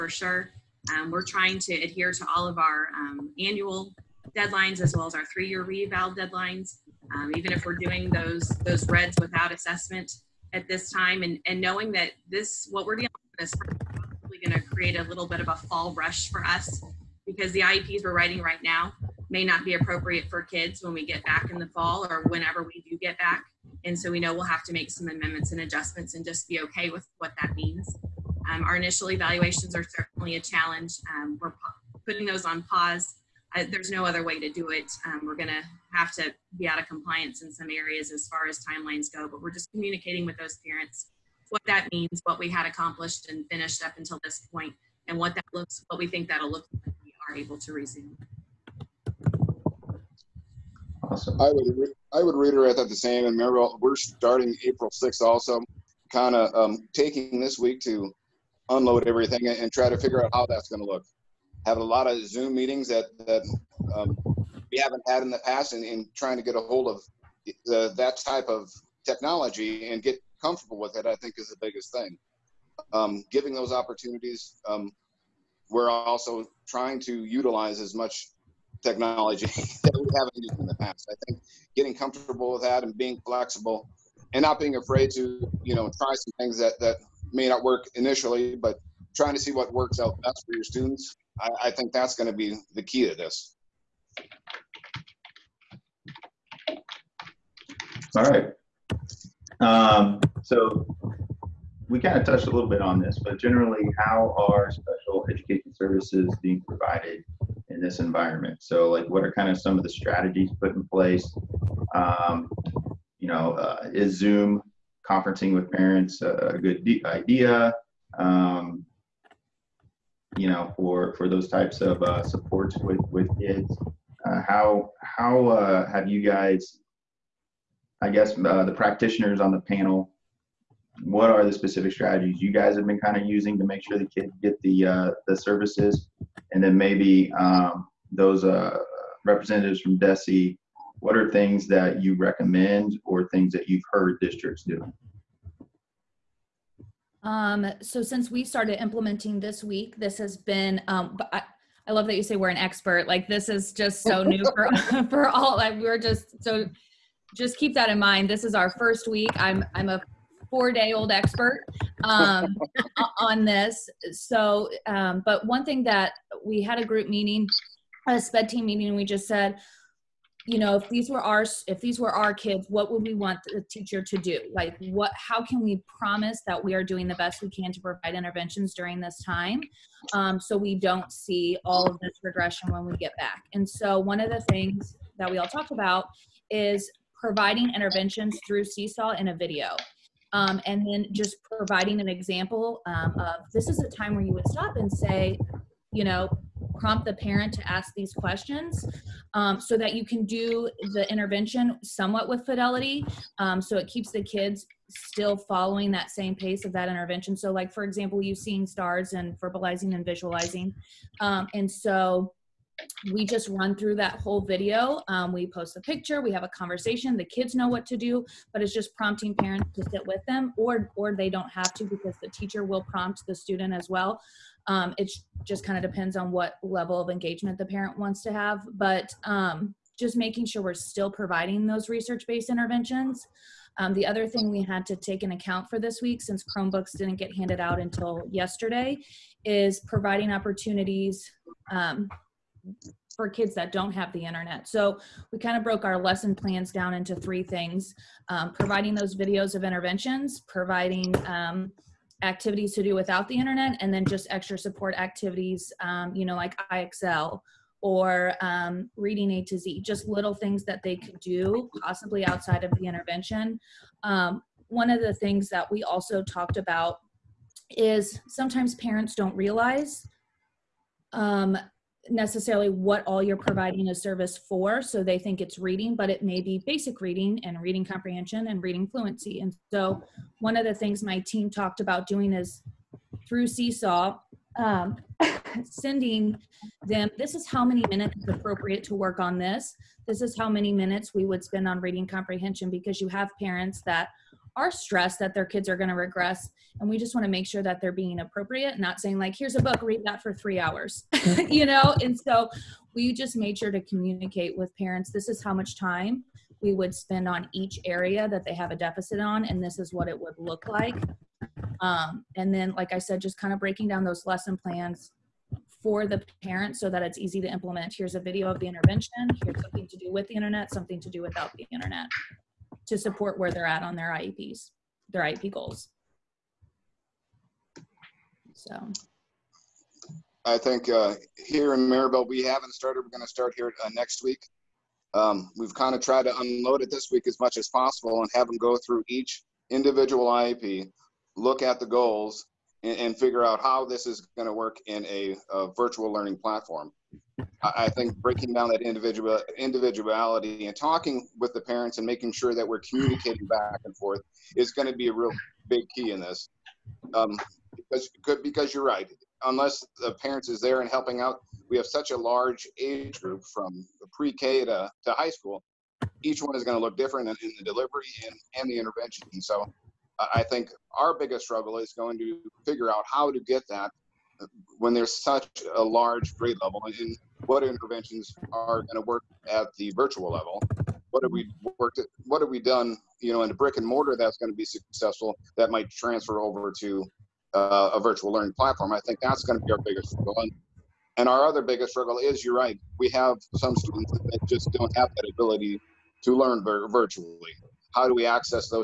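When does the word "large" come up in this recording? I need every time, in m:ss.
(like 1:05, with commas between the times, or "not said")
6:02, 6:15.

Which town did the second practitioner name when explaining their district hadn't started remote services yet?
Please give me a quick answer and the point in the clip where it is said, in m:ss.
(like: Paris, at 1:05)
Maryville, at 5:31.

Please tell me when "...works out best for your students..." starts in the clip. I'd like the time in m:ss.
1:29.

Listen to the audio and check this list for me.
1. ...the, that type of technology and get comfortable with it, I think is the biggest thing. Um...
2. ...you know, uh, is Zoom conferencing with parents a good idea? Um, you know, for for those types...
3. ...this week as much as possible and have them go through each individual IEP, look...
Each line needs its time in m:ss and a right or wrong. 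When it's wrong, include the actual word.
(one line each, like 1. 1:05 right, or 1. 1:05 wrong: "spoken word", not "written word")
1. 1:07 right
2. 1:53 right
3. 5:36 right.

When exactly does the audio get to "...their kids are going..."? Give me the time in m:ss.
4:55.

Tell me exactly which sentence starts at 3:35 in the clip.
Um, we post the picture, we have a conversation.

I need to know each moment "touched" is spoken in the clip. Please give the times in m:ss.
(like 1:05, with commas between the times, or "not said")
1:42.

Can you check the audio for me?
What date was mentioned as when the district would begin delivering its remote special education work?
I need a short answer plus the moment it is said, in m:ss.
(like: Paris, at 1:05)
April 6th, at 0:54.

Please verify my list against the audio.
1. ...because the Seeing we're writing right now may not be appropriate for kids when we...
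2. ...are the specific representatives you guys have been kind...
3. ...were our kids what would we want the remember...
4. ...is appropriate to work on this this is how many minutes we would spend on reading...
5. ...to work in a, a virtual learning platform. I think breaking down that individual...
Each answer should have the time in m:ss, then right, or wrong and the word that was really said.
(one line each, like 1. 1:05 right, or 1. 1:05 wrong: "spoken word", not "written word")
1. 0:17 wrong: "IEPs", not "Seeing"
2. 2:11 wrong: "strategies", not "representatives"
3. 2:51 wrong: "teacher", not "remember"
4. 4:48 right
5. 5:44 right.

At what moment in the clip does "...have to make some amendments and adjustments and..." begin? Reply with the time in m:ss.
0:24.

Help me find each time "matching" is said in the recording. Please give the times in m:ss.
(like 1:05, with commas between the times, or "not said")
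not said.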